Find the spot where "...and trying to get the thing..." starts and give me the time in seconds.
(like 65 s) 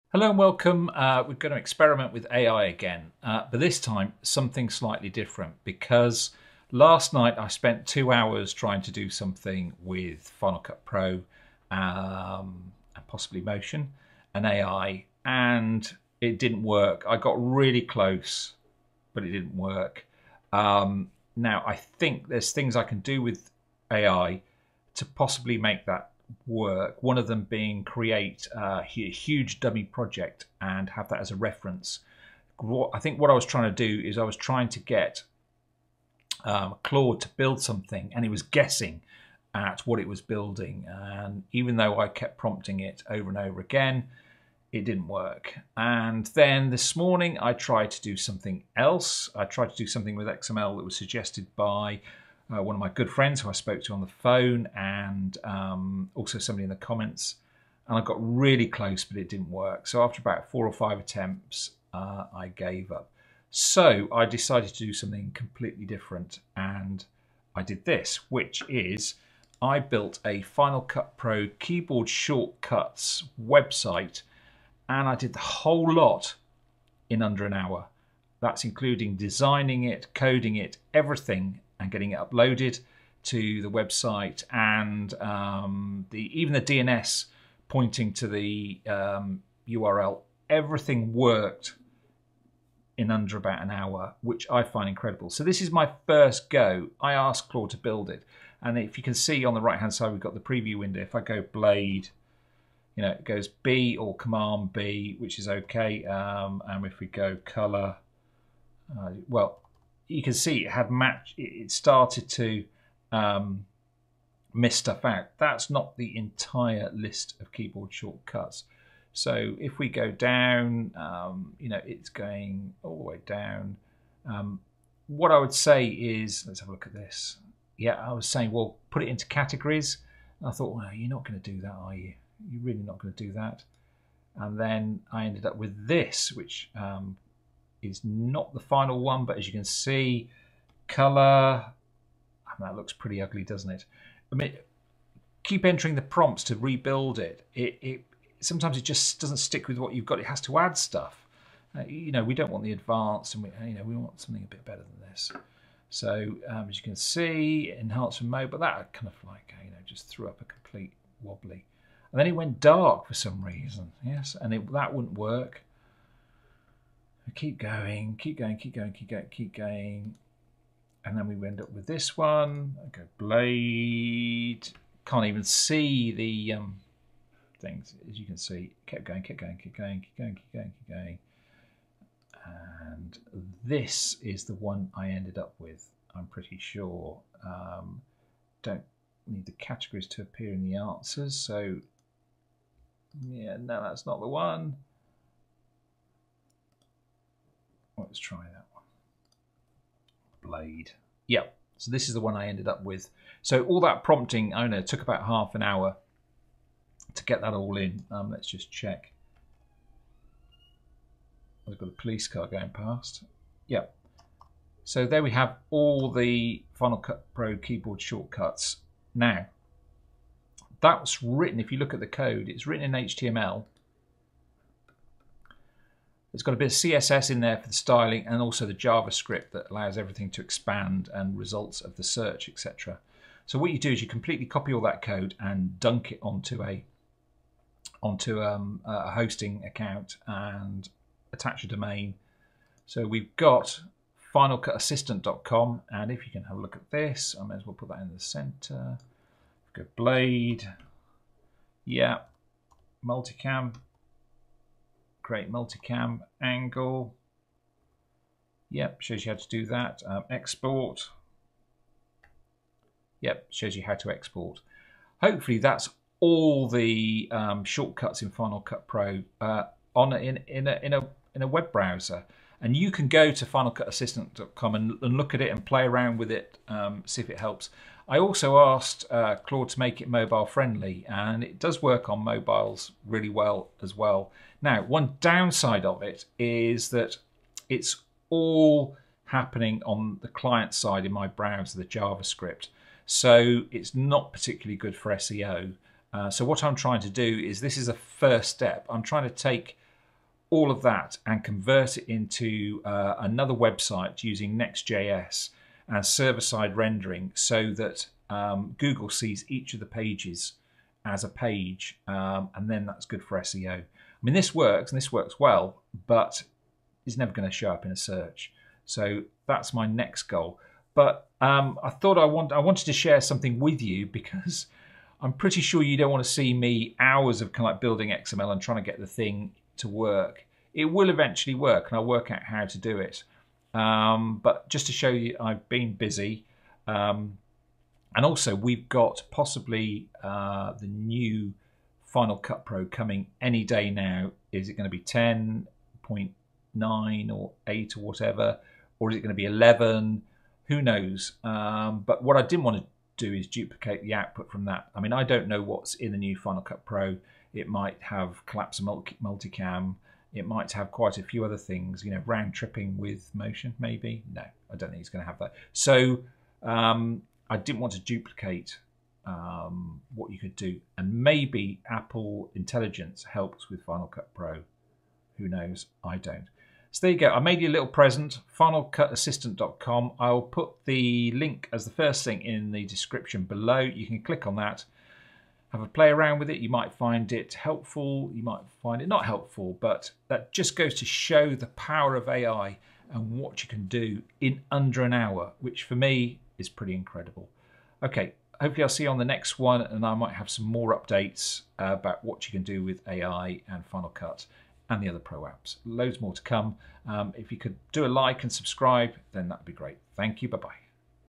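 328 s.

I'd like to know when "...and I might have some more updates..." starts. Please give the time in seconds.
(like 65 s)
399 s.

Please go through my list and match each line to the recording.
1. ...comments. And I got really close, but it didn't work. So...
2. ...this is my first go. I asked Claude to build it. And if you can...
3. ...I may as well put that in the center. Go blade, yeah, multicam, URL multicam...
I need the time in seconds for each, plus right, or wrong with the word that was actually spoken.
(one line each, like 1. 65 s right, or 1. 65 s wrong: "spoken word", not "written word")
1. 56 s right
2. 95 s right
3. 247 s wrong: "Create", not "URL".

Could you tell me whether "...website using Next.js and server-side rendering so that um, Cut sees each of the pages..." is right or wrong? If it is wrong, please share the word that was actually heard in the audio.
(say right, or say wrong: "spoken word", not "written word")
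wrong: "Google", not "Cut".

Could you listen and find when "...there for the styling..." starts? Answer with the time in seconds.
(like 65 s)
227 s.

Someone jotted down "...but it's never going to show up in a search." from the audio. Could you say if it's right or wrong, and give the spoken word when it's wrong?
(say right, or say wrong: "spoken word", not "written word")
right.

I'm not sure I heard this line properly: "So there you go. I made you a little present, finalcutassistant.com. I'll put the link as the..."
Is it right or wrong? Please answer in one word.
right.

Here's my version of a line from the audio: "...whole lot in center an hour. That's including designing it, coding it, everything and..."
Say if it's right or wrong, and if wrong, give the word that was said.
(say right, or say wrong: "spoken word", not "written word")
wrong: "under", not "center".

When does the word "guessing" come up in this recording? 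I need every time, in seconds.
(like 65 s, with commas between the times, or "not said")
38 s.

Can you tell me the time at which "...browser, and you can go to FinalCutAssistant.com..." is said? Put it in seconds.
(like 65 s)
271 s.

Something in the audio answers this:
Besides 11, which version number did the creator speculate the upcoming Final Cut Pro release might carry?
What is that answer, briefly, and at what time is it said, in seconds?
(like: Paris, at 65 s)
10.9, at 344 s.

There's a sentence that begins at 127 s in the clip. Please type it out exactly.
Yeah, I was saying, well, put it into categories.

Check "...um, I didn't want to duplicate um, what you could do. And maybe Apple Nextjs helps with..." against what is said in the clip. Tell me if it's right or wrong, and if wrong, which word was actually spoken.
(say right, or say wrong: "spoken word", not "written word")
wrong: "Intelligence", not "Nextjs".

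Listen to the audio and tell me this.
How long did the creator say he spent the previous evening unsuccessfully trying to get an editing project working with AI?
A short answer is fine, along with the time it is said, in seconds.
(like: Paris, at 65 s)
2 hours, at 7 s.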